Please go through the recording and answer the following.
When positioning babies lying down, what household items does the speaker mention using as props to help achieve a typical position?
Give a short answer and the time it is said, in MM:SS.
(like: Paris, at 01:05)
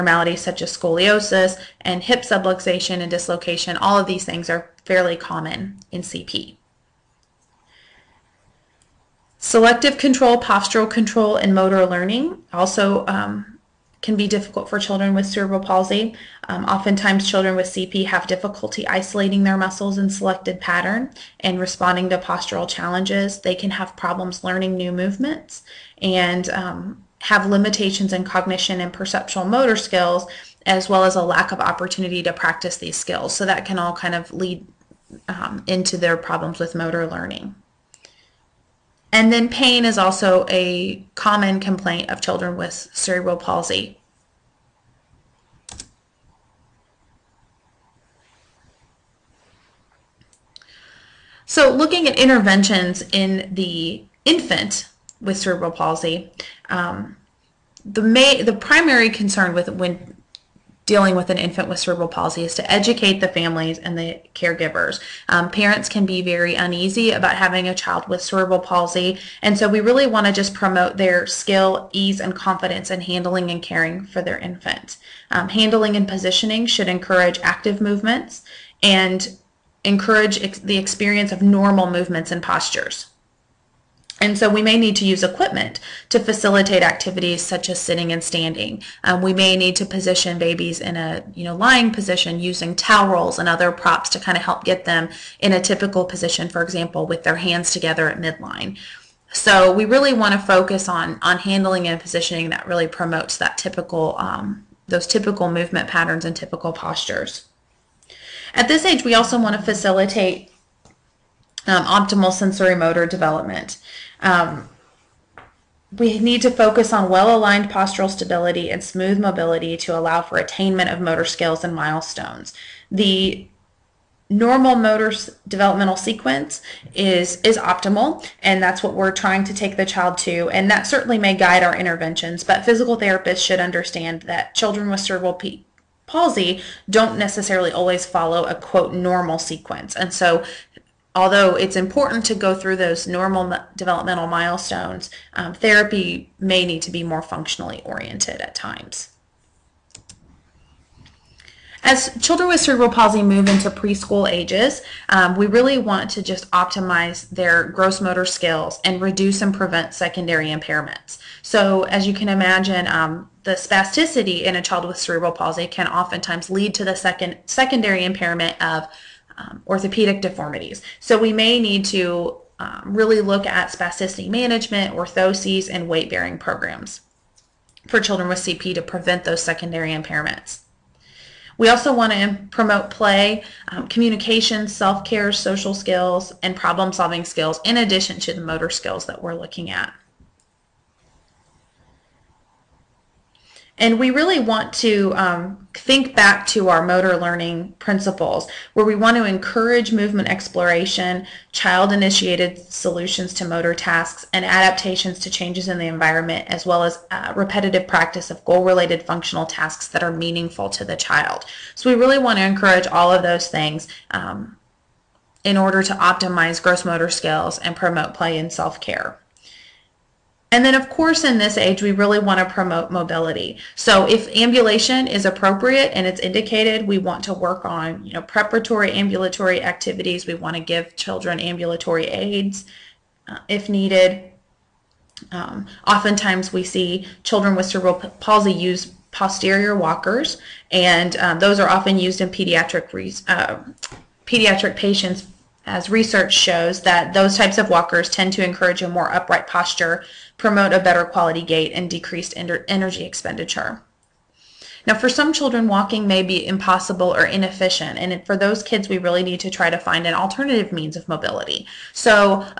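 Towel rolls, at 01:32.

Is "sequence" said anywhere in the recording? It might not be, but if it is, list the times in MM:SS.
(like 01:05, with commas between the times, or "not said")
02:05, 02:19.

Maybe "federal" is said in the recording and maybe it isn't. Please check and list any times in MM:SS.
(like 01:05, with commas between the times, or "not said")
not said.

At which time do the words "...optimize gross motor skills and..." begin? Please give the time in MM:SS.
03:35.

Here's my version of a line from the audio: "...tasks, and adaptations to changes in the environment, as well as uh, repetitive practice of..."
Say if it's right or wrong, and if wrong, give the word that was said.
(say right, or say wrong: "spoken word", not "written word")
right.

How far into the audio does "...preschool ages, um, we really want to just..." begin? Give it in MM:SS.
02:33.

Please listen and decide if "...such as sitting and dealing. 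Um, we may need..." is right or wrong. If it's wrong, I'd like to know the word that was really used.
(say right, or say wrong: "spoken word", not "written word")
wrong: "standing", not "dealing".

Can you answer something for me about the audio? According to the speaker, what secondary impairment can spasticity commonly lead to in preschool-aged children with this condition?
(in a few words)
Orthopedic deformities.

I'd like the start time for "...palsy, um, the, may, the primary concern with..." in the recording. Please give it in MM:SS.
00:55.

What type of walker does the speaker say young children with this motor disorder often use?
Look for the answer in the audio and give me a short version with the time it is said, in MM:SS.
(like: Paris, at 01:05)
Posterior walkers, at 03:59.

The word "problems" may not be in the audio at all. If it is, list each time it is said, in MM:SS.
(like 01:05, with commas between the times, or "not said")
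00:23, 00:36, 03:06.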